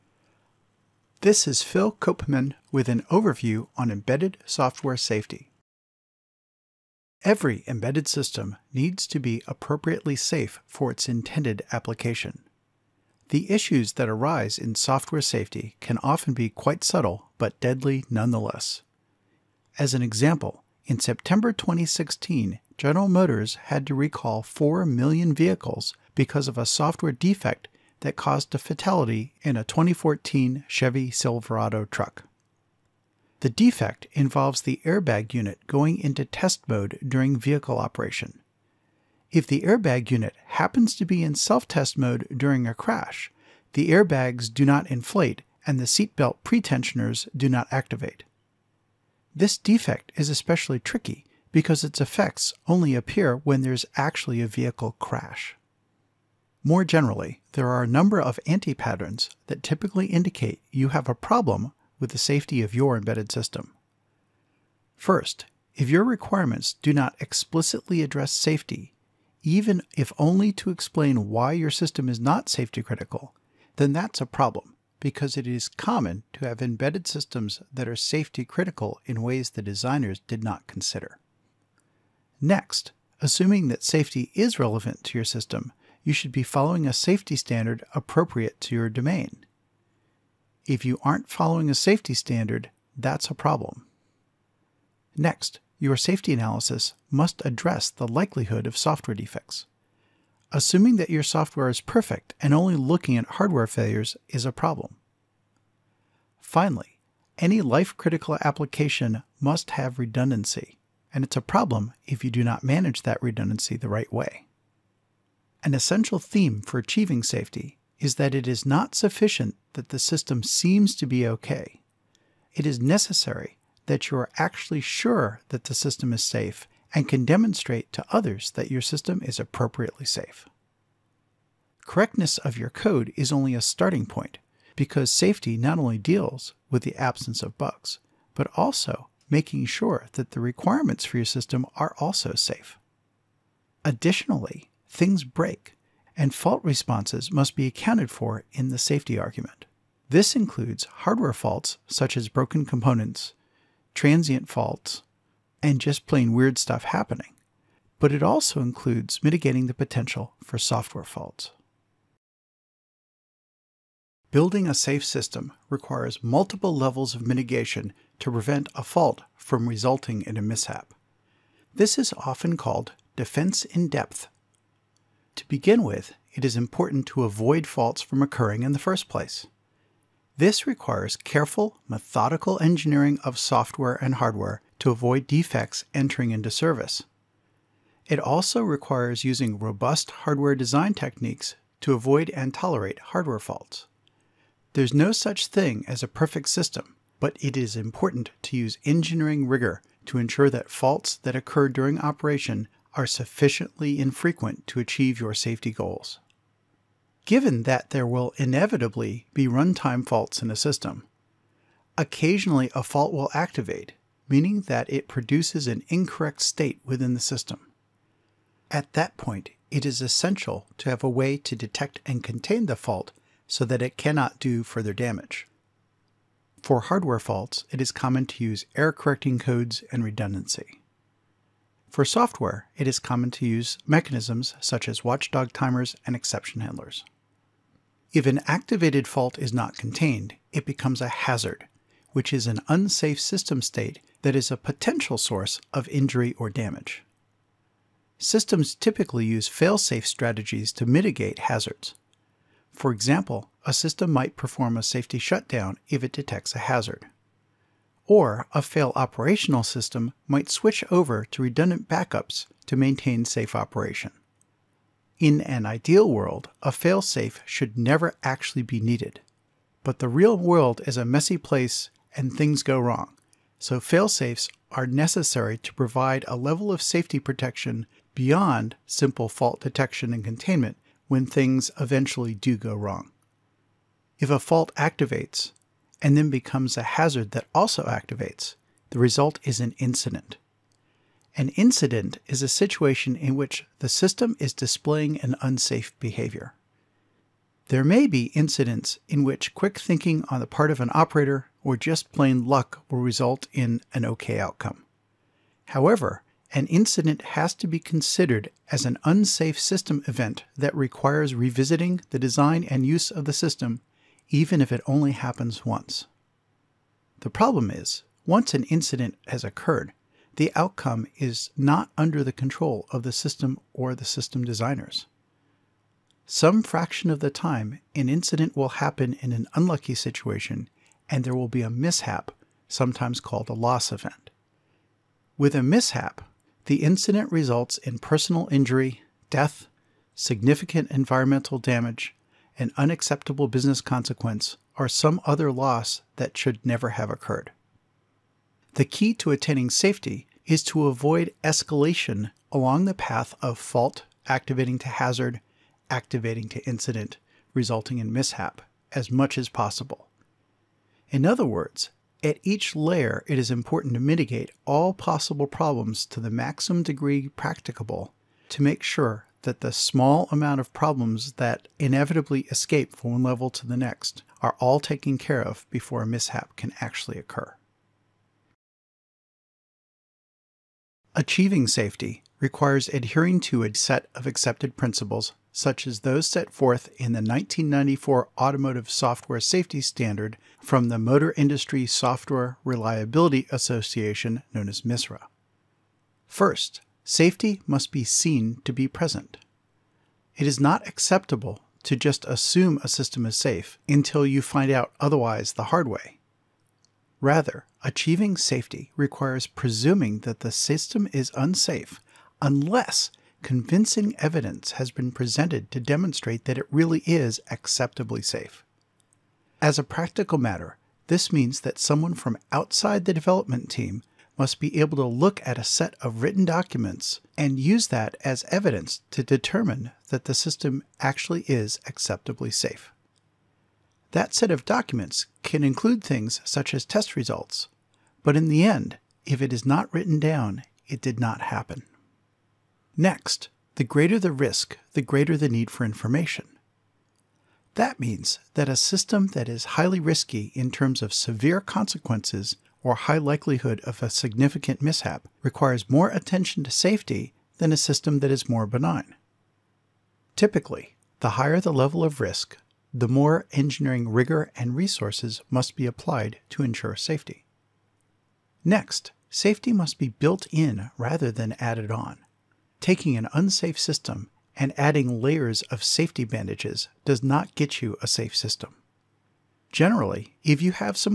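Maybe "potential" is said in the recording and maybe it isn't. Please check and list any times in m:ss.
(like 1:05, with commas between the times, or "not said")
2:39, 4:04.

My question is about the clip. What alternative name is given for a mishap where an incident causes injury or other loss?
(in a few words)
Loss event.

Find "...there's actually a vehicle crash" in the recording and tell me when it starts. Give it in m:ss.
0:53.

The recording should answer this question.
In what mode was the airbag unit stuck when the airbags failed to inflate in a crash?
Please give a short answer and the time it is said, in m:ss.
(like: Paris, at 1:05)
Self test mode, at 0:41.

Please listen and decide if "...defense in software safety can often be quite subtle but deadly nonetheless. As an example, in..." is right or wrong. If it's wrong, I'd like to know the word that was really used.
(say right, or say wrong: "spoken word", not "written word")
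wrong: "arise", not "defense".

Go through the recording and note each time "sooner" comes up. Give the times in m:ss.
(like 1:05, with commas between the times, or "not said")
not said.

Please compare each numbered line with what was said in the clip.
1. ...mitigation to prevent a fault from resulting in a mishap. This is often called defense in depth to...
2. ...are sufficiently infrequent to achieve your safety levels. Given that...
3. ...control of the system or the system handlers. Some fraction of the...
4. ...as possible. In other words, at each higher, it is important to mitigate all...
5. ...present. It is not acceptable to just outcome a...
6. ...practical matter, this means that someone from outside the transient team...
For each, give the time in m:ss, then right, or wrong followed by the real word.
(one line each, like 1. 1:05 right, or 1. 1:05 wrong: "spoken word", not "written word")
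1. 2:47 right
2. 3:22 wrong: "goals", not "levels"
3. 5:22 wrong: "designers", not "handlers"
4. 5:59 wrong: "layer", not "higher"
5. 6:38 wrong: "assume", not "outcome"
6. 6:59 wrong: "development", not "transient".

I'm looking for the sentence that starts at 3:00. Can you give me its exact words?
This requires careful, methodical engineering of software and hardware to avoid defects entering into service.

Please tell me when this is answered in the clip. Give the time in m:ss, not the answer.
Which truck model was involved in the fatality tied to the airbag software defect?
0:29.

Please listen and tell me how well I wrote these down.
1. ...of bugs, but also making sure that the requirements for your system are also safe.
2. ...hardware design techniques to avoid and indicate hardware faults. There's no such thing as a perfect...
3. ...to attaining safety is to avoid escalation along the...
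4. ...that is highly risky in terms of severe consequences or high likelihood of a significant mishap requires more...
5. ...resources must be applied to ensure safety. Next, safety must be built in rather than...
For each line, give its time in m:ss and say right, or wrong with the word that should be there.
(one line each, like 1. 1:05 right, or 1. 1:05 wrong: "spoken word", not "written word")
1. 2:17 right
2. 3:10 wrong: "tolerate", not "indicate"
3. 5:49 right
4. 7:29 right
5. 7:44 right.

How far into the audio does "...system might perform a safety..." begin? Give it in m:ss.
4:13.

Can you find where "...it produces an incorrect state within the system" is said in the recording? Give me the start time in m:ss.
3:34.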